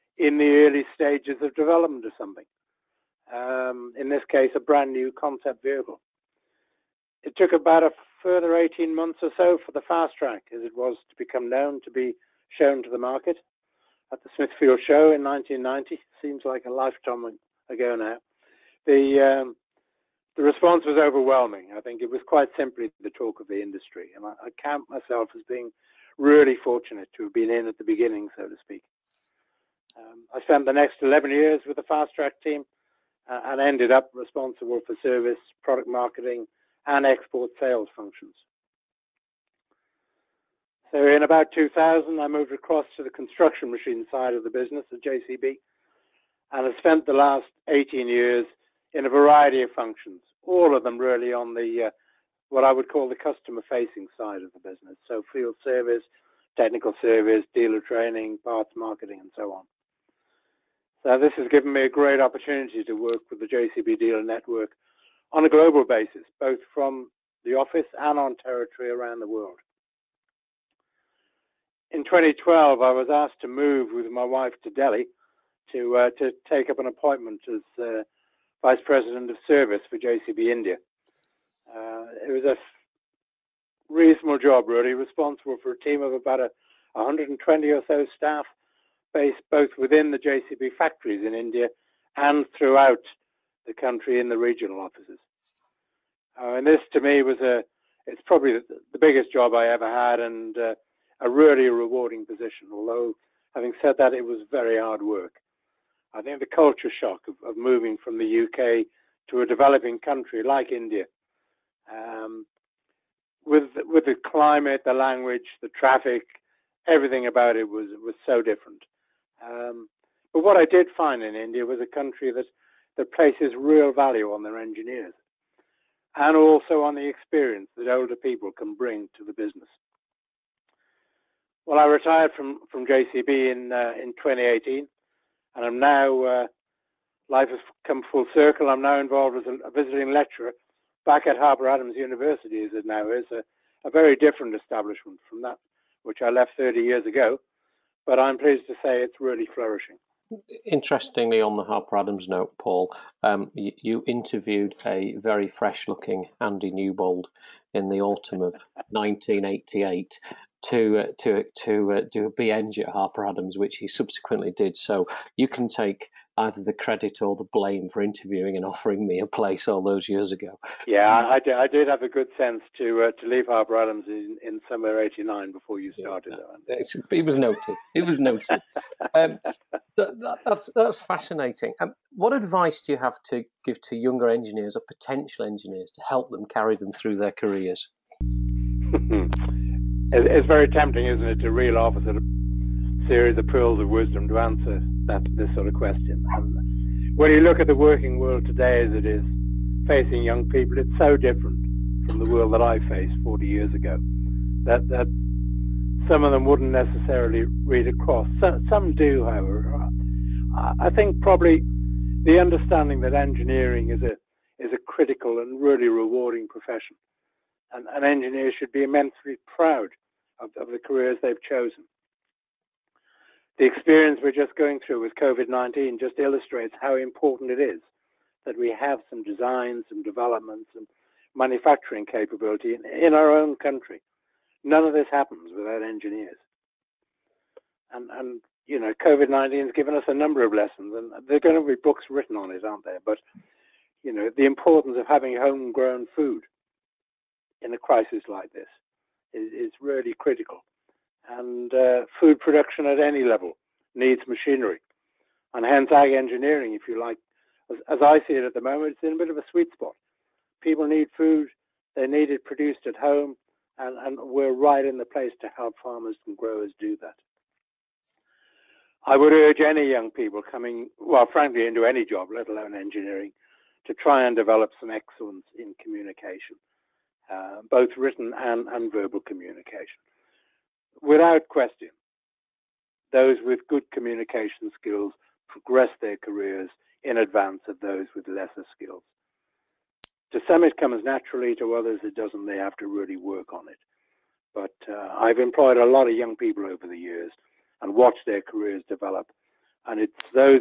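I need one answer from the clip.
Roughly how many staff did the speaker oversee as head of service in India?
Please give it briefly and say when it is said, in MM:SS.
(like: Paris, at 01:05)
120, at 01:26.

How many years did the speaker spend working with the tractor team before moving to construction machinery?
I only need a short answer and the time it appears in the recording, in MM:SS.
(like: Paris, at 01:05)
11, at 00:31.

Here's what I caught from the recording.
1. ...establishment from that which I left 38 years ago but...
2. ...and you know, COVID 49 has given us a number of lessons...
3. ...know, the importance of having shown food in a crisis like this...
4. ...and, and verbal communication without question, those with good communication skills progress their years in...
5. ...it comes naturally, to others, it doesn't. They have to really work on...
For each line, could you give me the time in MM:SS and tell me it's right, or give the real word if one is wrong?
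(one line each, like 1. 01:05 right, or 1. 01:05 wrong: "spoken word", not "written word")
1. 02:24 wrong: "30", not "38"
2. 03:58 wrong: "19", not "49"
3. 04:04 wrong: "homegrown", not "shown"
4. 04:38 wrong: "careers", not "years"
5. 04:50 right.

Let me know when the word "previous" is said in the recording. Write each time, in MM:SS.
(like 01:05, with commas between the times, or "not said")
not said.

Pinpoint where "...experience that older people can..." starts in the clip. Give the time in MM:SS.
02:07.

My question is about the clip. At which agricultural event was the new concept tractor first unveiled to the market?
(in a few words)
Smithfield Show.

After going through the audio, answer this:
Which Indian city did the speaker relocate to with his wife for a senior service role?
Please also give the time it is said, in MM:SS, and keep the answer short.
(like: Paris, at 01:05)
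Delhi, at 01:14.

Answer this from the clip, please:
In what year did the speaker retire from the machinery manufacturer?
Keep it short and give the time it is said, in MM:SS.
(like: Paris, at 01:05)
2018, at 02:14.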